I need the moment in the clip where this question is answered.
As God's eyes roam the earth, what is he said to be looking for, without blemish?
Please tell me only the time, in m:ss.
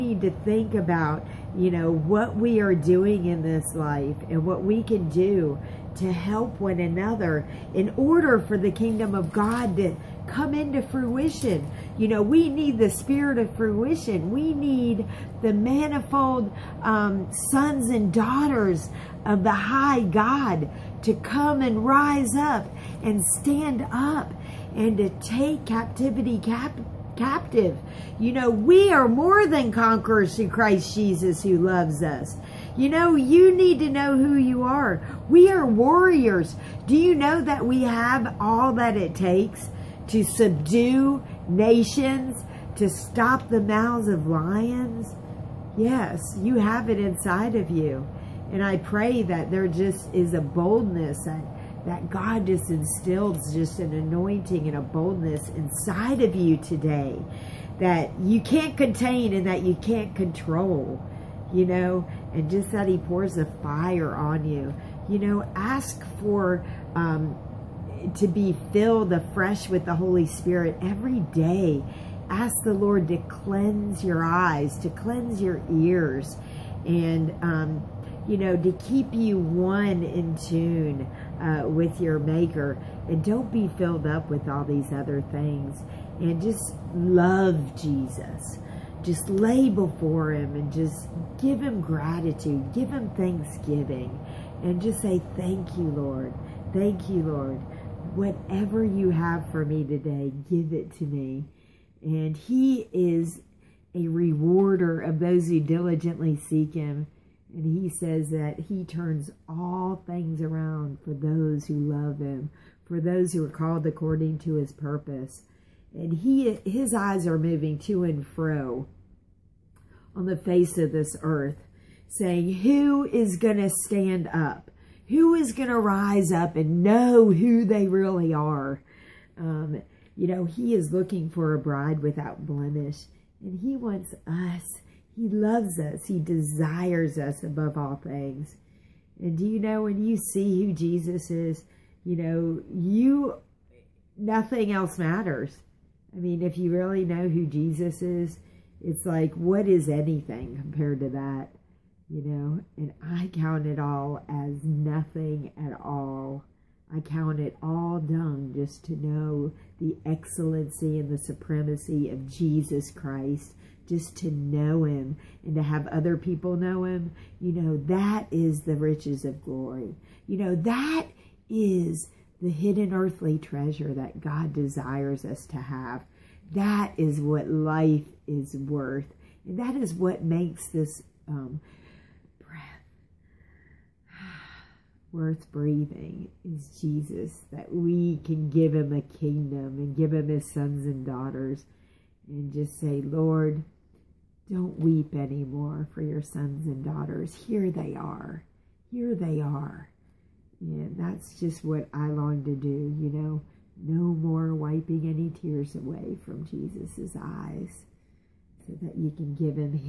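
2:11.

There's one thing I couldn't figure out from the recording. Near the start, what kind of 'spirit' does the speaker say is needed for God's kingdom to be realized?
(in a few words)
The spirit of fruition.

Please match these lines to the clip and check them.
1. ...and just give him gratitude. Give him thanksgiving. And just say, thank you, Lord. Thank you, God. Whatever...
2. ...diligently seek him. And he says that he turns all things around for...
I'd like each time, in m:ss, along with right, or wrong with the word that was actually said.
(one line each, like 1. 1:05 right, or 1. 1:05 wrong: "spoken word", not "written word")
1. 1:30 wrong: "Lord", not "God"
2. 1:45 right.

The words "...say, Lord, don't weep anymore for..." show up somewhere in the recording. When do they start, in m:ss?
3:12.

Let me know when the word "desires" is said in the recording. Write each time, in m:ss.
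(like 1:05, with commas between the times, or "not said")
2:16, 2:54.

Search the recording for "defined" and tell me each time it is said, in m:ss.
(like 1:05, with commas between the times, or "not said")
not said.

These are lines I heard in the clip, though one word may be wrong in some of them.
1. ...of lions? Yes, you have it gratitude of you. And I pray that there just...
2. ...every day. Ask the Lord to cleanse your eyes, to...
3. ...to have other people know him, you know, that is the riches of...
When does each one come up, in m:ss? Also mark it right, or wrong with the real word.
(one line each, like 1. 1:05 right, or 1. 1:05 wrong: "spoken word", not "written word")
1. 0:44 wrong: "inside", not "gratitude"
2. 1:10 right
3. 2:45 right.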